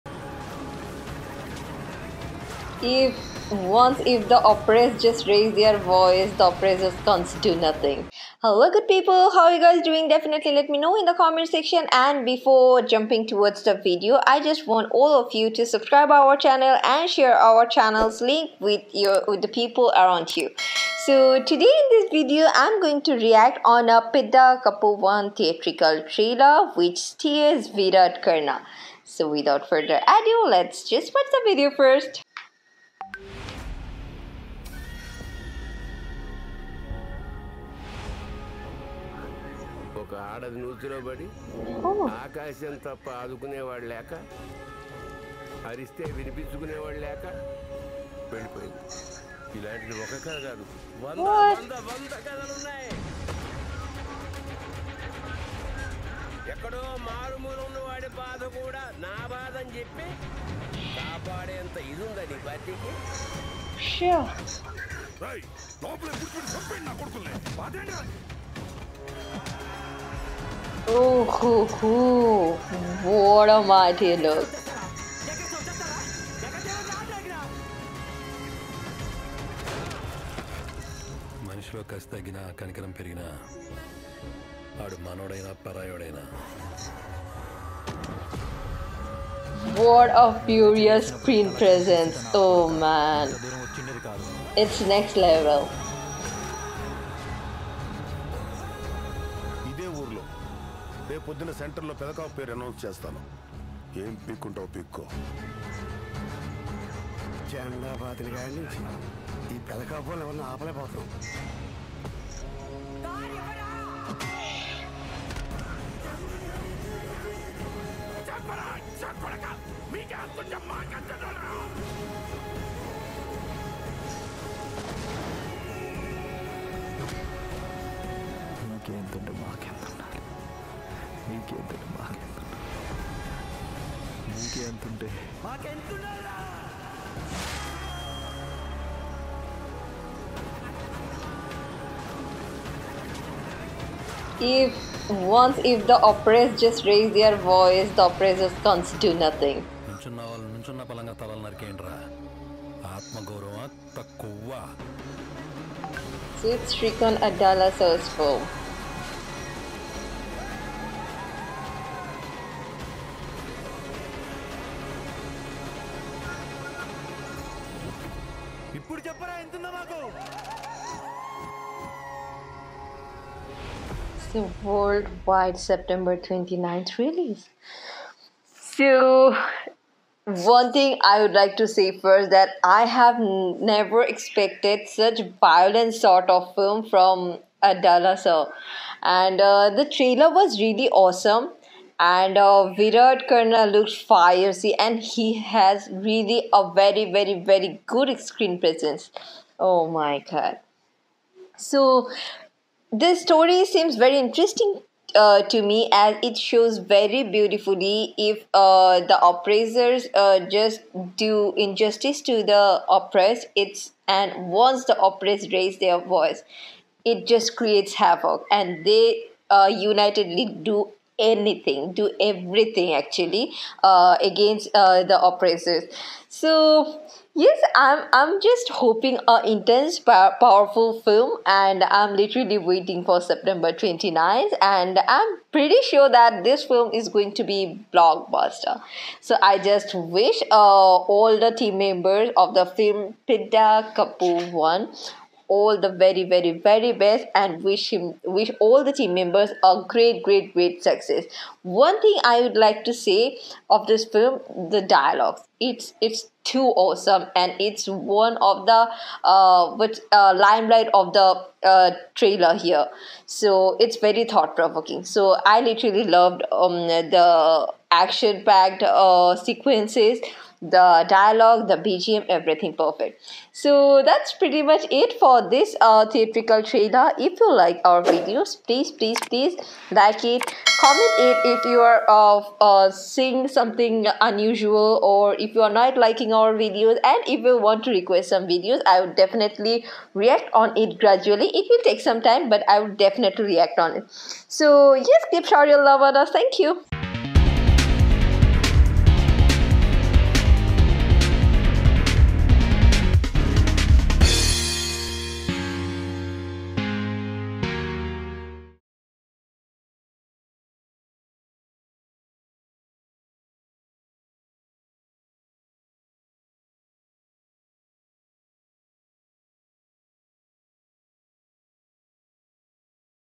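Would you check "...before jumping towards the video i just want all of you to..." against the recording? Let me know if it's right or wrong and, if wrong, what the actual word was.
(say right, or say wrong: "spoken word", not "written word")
right.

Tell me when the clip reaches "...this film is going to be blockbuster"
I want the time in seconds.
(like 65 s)
236 s.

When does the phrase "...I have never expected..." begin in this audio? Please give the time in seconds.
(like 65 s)
182 s.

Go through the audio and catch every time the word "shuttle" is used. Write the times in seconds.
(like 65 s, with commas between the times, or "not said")
not said.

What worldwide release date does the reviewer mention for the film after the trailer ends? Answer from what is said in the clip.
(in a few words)
September 29th.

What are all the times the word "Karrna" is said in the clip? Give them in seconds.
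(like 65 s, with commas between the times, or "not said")
28 s, 193 s.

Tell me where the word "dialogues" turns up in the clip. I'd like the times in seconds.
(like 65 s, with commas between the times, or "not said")
254 s, 271 s.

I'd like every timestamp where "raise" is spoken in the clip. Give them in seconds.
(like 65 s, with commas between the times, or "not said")
5 s, 146 s, 215 s.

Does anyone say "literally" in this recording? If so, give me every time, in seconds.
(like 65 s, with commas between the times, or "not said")
232 s, 265 s.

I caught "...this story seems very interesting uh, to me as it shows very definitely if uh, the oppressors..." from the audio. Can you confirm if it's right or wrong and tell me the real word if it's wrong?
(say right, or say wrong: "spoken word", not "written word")
wrong: "beautifully", not "definitely".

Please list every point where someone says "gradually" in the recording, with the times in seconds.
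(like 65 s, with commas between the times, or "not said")
290 s.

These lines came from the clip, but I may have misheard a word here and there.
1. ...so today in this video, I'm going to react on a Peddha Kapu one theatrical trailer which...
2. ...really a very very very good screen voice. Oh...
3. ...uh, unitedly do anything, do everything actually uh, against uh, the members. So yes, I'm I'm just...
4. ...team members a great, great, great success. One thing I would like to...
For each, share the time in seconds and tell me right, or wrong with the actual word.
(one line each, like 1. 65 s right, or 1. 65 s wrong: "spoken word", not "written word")
1. 21 s right
2. 195 s wrong: "presence", not "voice"
3. 219 s wrong: "oppressors", not "members"
4. 248 s right.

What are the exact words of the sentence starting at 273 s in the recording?
So that's pretty much it for this uh, theatrical trailer.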